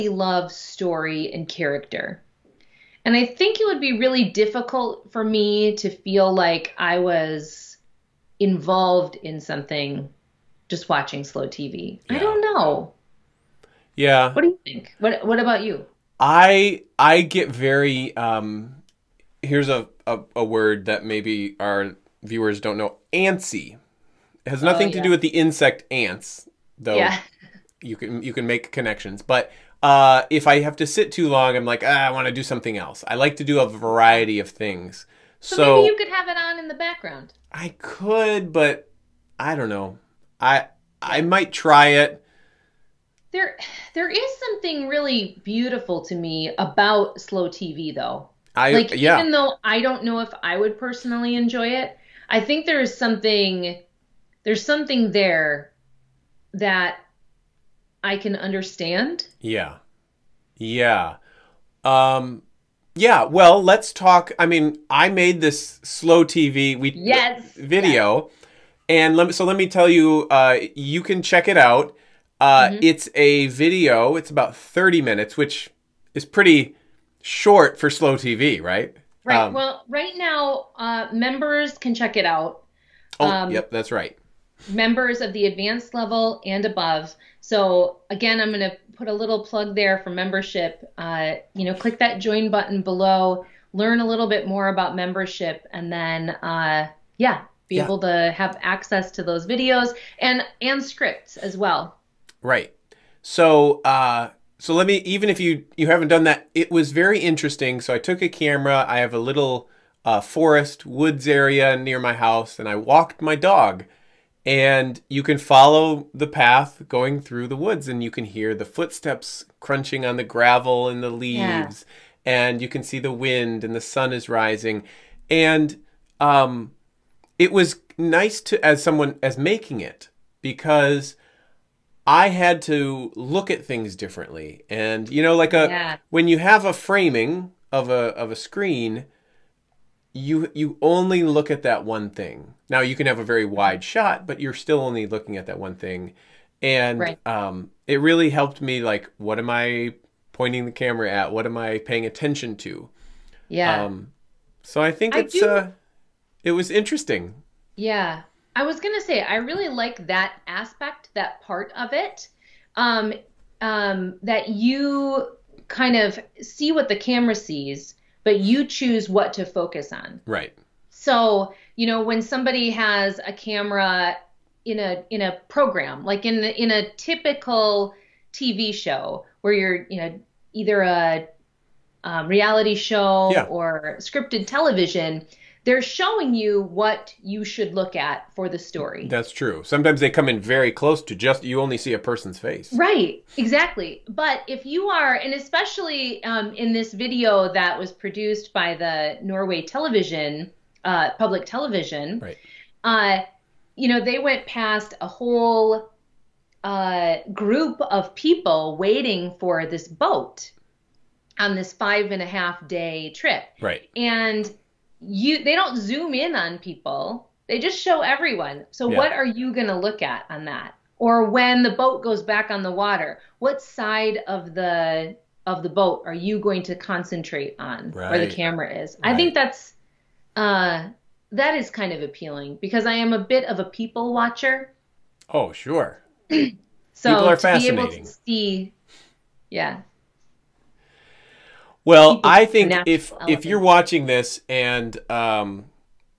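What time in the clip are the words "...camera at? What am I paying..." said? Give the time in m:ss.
2:30.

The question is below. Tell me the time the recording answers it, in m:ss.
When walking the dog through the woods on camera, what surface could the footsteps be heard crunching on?
2:00.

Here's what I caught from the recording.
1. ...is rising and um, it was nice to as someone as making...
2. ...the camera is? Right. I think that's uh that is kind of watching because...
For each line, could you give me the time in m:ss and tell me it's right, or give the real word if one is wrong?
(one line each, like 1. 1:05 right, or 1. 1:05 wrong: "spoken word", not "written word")
1. 2:04 right
2. 3:48 wrong: "appealing", not "watching".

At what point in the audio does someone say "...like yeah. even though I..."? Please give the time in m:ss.
0:48.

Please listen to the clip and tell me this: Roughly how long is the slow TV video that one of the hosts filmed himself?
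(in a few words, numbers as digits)
30 minutes.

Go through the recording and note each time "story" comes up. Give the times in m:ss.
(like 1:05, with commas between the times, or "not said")
0:00, 3:08.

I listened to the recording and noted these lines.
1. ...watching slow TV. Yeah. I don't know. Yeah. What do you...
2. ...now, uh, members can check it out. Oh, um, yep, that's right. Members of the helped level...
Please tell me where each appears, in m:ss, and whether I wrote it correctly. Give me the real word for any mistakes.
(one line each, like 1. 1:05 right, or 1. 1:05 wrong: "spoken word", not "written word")
1. 0:10 right
2. 1:20 wrong: "advanced", not "helped".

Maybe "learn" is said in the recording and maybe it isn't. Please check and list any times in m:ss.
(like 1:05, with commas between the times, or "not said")
1:33.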